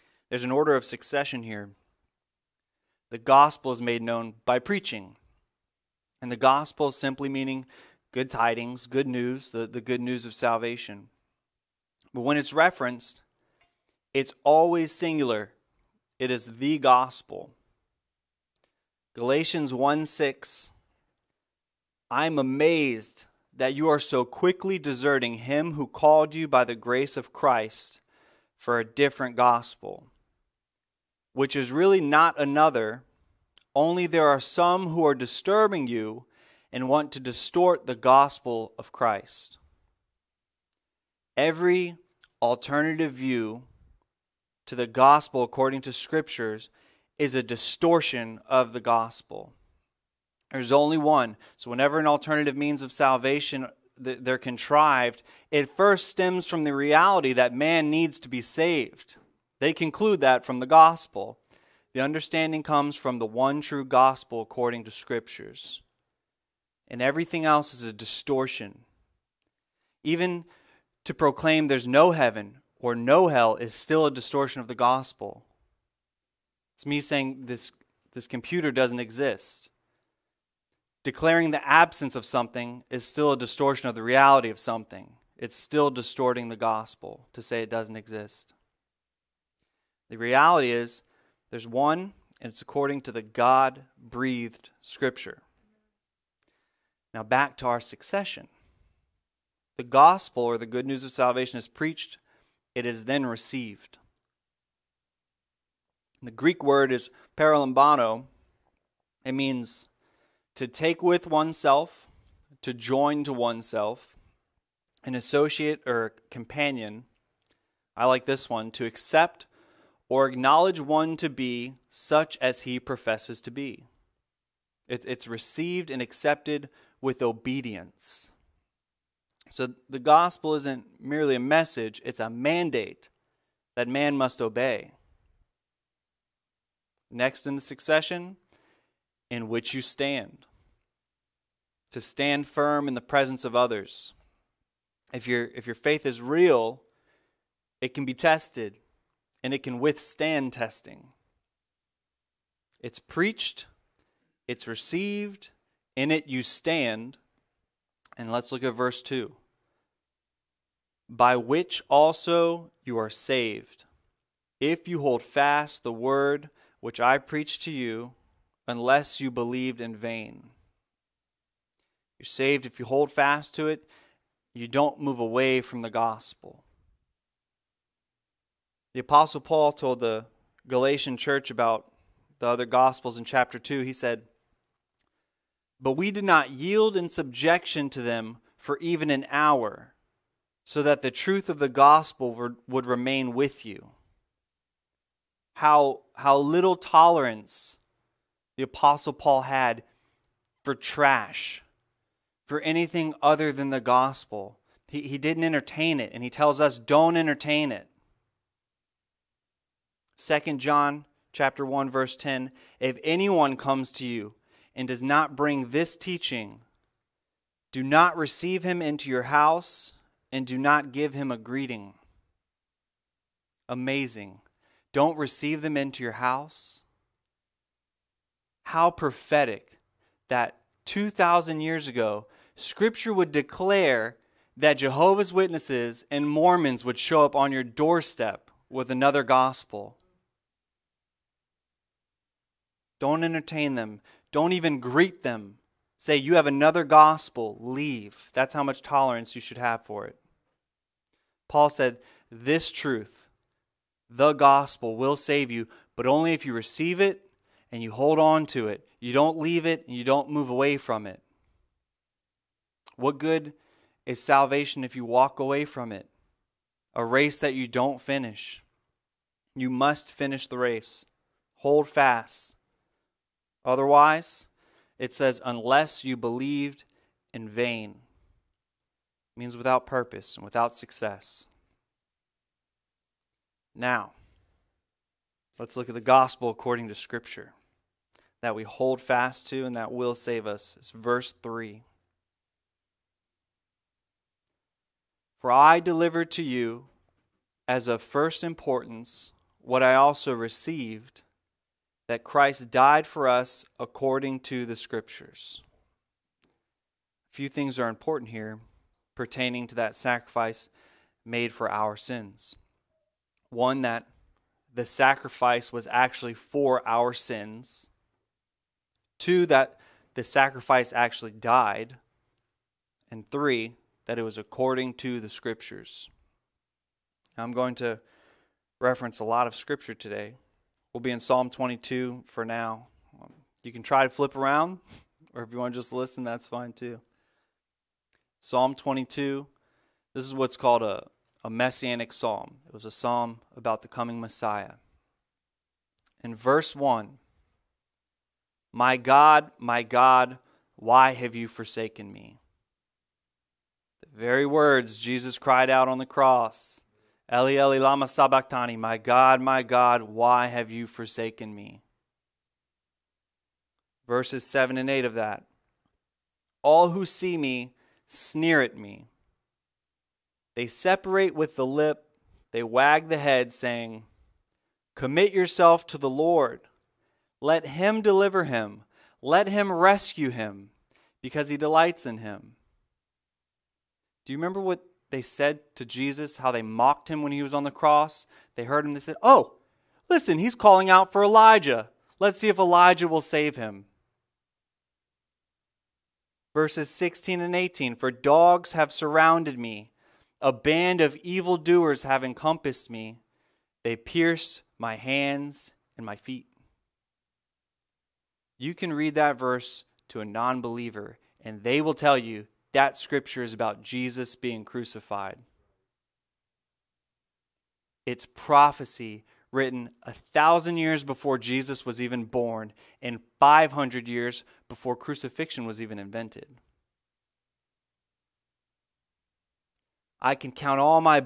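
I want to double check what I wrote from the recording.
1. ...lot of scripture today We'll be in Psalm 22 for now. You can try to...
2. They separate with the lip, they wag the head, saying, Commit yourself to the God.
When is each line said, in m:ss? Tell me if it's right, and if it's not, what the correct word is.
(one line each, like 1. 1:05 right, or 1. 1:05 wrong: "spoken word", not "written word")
1. 5:29 right
2. 6:10 wrong: "Lord", not "God".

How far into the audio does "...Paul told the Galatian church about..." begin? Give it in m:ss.
2:59.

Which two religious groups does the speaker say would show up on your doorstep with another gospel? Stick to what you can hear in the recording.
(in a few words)
Jehovah's Witnesses and Mormons.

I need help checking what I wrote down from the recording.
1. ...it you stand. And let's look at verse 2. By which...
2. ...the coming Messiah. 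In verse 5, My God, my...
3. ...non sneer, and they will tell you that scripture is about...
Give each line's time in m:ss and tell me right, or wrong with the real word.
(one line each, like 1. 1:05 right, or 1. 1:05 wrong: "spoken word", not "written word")
1. 2:36 right
2. 5:43 wrong: "1", not "5"
3. 6:50 wrong: "believer", not "sneer".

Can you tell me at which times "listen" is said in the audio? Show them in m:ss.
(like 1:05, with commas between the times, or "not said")
5:35, 6:30.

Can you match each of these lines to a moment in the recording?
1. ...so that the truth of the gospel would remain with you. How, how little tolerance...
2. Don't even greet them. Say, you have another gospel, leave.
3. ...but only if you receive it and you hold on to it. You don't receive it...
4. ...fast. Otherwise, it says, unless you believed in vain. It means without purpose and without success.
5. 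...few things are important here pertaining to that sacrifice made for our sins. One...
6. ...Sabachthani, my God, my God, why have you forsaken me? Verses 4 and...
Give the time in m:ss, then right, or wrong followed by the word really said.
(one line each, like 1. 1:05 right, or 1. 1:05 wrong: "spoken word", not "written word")
1. 3:10 right
2. 4:04 right
3. 4:15 wrong: "leave", not "receive"
4. 4:31 right
5. 5:07 right
6. 5:58 wrong: "7", not "4".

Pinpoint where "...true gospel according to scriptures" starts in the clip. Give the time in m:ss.
1:03.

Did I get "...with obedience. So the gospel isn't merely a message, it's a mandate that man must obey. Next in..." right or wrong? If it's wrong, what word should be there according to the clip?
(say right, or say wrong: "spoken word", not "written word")
right.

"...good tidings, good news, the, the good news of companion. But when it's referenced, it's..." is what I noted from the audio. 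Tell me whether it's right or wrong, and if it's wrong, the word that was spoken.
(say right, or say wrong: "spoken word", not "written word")
wrong: "salvation", not "companion".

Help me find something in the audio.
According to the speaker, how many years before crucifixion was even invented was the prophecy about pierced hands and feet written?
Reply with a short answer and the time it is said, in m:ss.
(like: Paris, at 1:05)
500, at 7:03.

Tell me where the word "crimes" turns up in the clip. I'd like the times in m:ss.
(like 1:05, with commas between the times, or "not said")
not said.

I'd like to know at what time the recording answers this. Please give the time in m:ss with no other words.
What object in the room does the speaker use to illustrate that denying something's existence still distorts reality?
1:18.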